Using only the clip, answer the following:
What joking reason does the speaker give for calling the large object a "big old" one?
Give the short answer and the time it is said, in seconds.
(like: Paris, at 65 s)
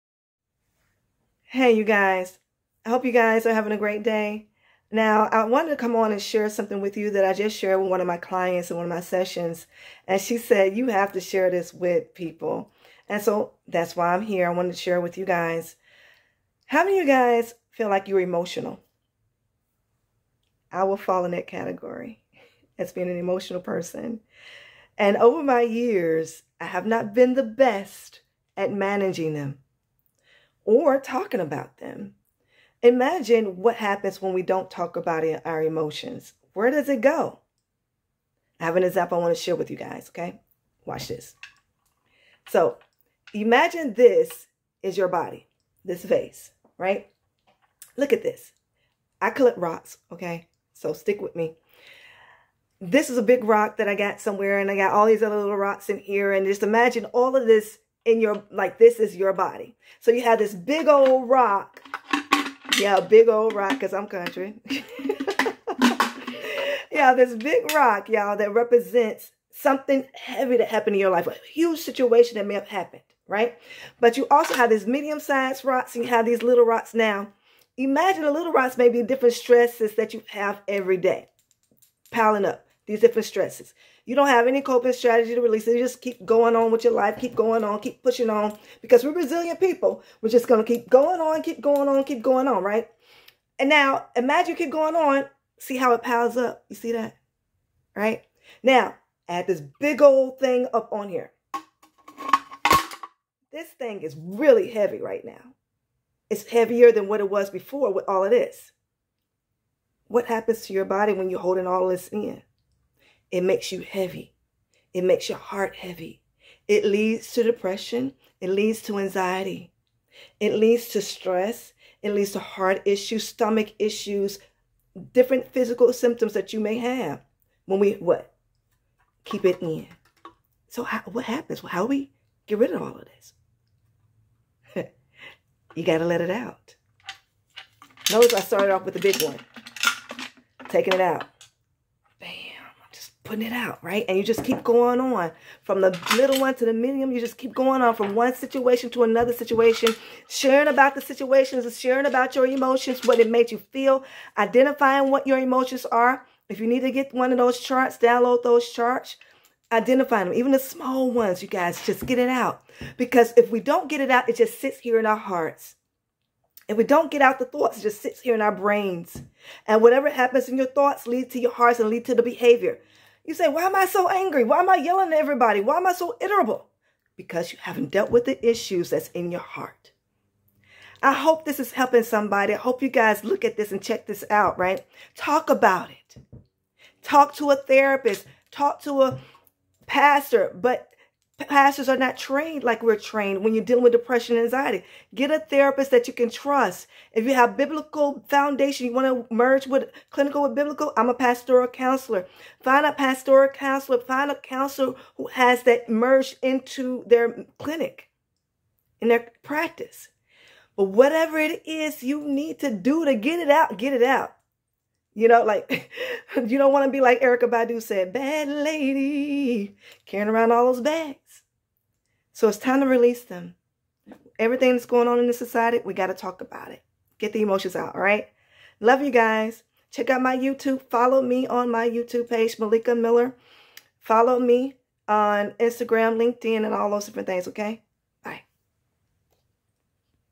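because I'm country, at 63 s.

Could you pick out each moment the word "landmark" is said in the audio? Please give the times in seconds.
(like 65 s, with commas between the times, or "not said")
not said.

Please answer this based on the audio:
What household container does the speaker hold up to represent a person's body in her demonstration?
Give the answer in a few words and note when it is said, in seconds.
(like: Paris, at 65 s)
vase, at 46 s.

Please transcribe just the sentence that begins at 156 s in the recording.
If you need to get one of those charts, download those charts.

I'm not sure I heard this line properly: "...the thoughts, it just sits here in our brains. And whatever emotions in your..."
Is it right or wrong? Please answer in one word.
wrong.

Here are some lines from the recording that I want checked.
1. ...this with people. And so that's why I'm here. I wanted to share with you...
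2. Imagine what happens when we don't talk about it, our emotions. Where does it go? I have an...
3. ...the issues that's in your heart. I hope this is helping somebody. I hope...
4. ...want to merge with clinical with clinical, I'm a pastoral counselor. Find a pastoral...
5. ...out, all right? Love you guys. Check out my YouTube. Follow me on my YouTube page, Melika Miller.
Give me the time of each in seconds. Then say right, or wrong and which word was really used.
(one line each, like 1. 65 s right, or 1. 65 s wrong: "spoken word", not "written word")
1. 11 s right
2. 32 s right
3. 178 s right
4. 198 s wrong: "biblical", not "clinical"
5. 227 s right.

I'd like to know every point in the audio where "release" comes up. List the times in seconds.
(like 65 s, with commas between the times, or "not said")
85 s, 222 s.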